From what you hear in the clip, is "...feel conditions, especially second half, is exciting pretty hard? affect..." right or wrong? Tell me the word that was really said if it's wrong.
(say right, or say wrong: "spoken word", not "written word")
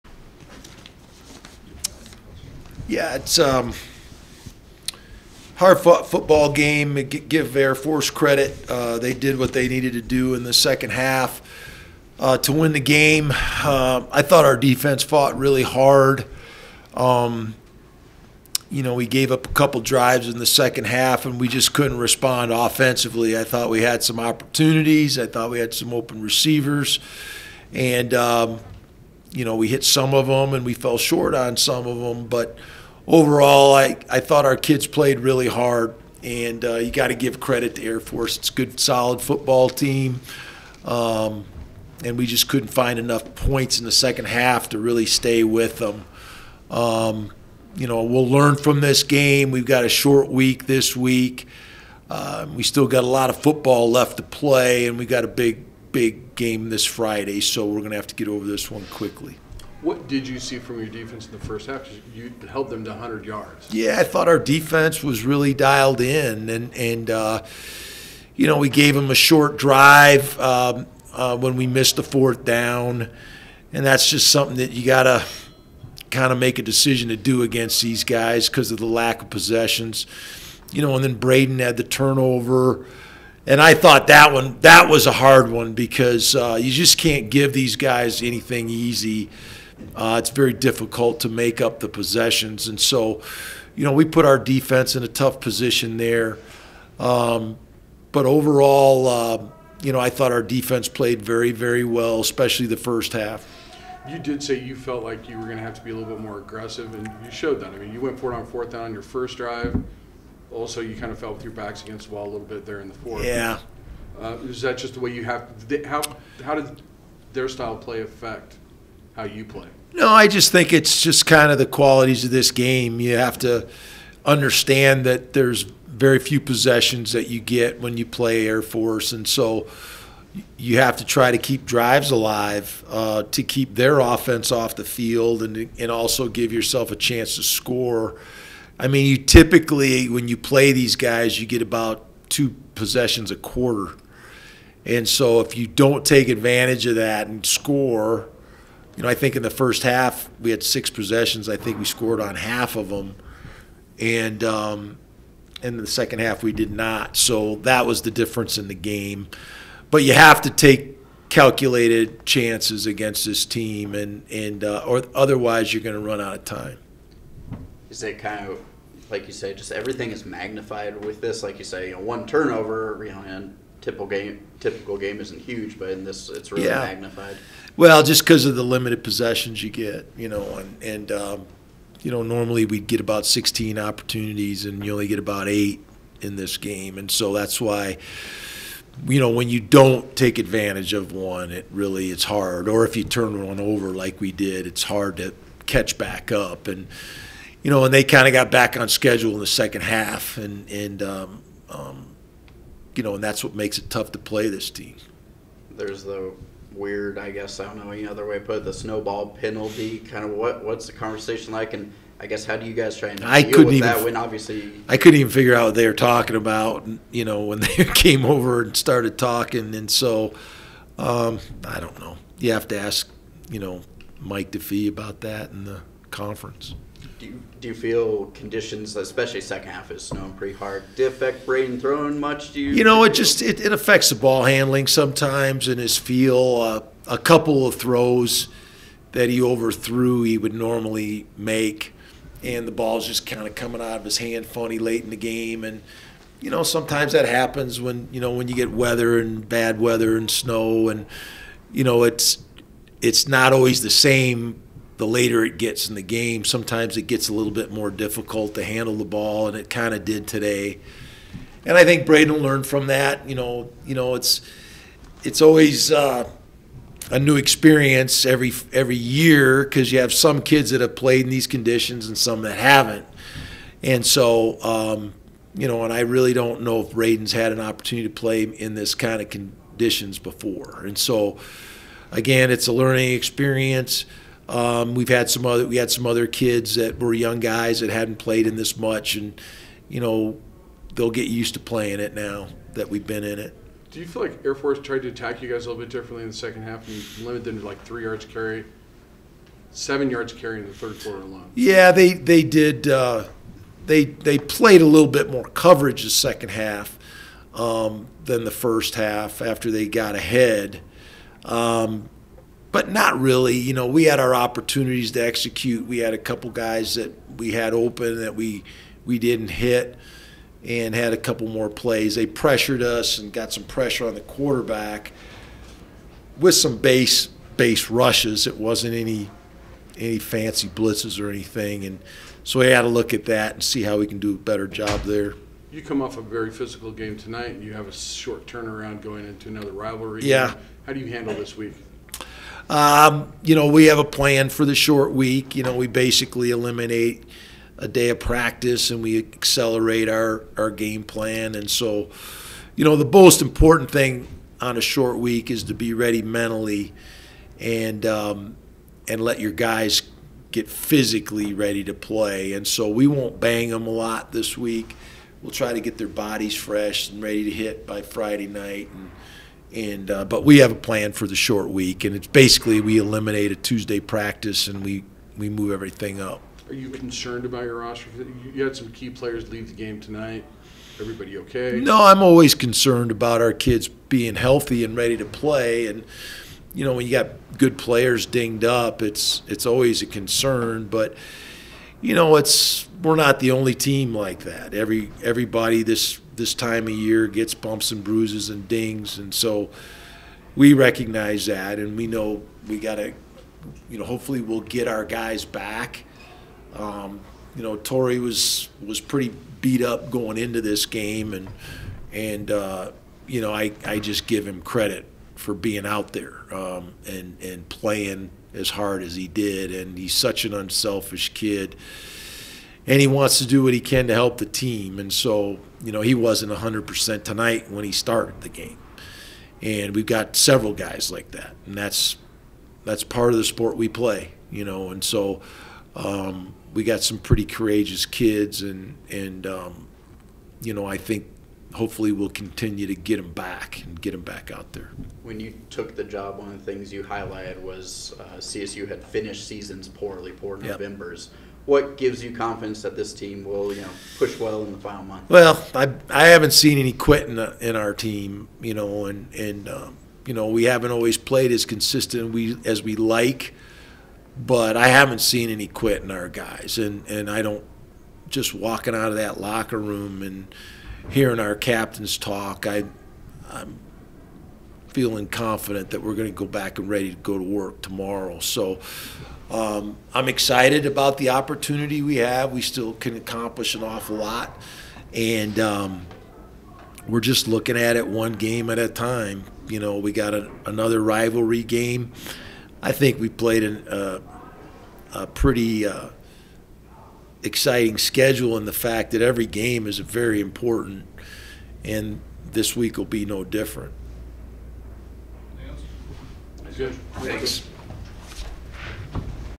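wrong: "snowing", not "exciting".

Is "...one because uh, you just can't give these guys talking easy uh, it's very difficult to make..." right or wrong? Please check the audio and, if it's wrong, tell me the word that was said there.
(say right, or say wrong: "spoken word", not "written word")
wrong: "anything", not "talking".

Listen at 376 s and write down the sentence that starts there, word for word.
Are you concerned about your roster?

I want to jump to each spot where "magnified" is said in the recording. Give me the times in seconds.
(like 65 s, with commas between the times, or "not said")
170 s, 176 s.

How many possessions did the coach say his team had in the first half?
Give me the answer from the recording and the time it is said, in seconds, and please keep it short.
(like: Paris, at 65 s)
6, at 150 s.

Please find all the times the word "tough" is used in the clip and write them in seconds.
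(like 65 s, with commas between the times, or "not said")
95 s, 203 s.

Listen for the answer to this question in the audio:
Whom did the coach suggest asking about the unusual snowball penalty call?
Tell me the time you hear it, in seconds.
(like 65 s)
224 s.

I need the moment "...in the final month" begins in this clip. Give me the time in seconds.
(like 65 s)
454 s.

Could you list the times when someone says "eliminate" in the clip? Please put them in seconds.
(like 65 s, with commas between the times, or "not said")
346 s, 372 s.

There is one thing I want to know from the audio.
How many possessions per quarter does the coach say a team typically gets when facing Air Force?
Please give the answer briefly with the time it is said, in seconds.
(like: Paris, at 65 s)
2, at 142 s.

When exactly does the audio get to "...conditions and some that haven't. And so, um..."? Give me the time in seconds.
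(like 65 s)
271 s.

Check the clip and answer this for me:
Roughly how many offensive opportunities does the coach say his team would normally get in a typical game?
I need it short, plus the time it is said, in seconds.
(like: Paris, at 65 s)
16, at 183 s.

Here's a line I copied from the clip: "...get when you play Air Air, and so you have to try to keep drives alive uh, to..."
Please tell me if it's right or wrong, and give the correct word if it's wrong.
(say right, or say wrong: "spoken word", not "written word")
wrong: "Force", not "Air".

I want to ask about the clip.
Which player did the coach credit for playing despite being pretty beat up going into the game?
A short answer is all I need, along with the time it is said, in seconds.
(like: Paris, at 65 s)
Tory, at 407 s.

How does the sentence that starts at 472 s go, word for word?
I I'm feeling confident that we're going to go back and ready to go to work tomorrow.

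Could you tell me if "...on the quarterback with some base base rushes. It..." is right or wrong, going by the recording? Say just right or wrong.
right.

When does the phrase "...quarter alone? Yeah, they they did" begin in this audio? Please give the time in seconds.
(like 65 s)
301 s.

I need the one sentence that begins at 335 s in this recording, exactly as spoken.
You come off a very physical game tonight, and you have a short turnaround going into another rivalry.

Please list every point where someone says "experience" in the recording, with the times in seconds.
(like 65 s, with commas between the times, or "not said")
267 s, 283 s.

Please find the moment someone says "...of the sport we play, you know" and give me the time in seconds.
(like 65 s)
433 s.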